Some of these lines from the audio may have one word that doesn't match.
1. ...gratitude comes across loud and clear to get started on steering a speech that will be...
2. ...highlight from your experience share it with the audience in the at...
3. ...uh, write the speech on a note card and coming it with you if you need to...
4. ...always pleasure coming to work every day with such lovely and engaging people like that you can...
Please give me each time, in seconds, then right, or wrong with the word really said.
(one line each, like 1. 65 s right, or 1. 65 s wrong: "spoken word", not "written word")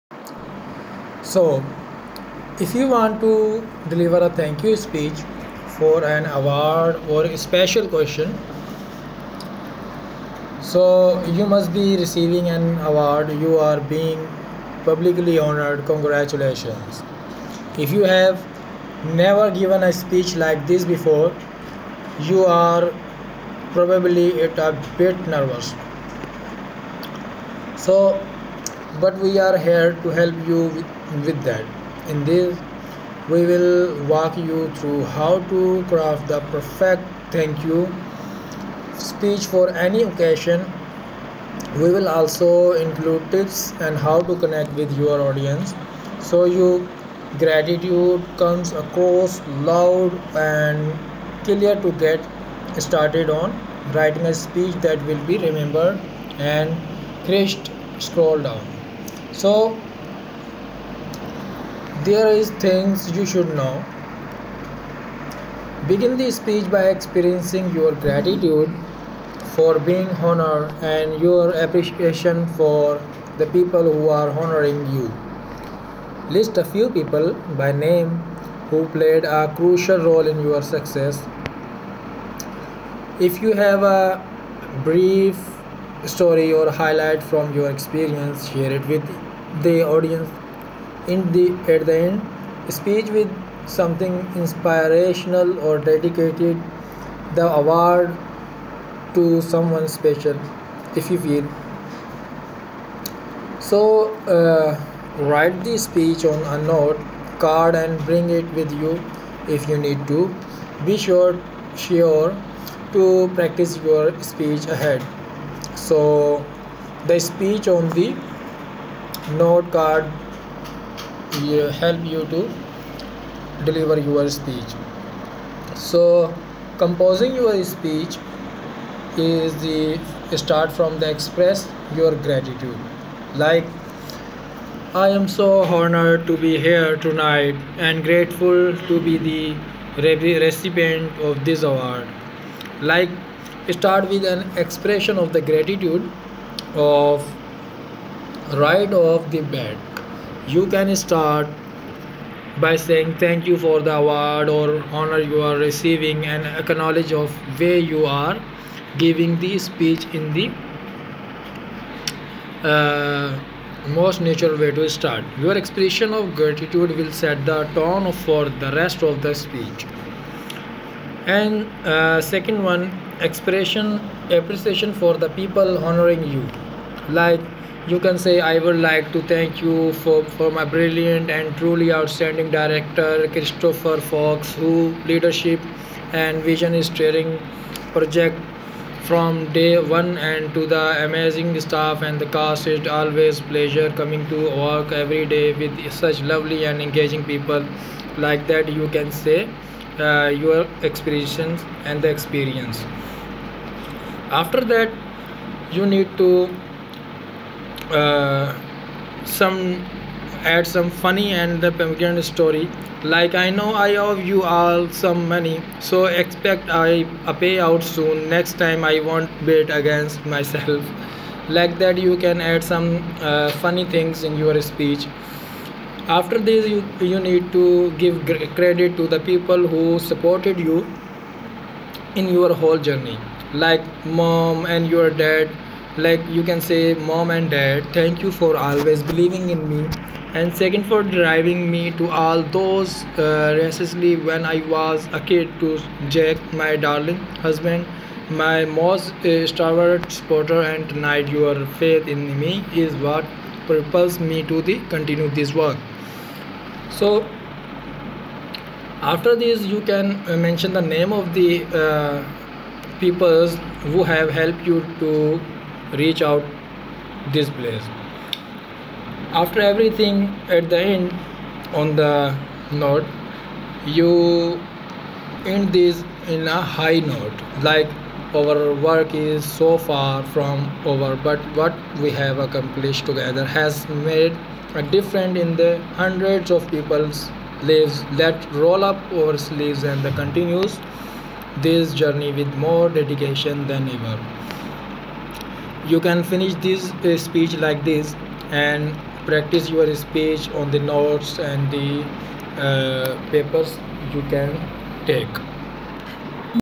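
1. 47 s wrong: "writing", not "steering"
2. 86 s right
3. 104 s wrong: "bring", not "coming"
4. 192 s right.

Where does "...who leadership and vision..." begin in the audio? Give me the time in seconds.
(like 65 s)
184 s.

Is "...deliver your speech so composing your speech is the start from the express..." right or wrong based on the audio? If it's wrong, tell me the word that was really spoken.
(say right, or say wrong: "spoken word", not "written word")
right.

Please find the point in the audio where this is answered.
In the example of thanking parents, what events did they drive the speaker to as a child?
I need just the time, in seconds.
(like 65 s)
243 s.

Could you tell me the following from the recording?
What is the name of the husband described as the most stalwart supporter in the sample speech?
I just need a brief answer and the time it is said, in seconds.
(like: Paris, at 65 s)
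Jack, at 246 s.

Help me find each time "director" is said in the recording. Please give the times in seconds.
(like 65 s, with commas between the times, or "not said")
182 s.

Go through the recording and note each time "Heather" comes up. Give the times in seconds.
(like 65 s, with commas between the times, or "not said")
not said.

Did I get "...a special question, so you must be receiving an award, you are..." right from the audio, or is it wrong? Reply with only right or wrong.
right.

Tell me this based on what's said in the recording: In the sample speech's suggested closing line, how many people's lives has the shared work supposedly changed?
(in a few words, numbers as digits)
Hundreds.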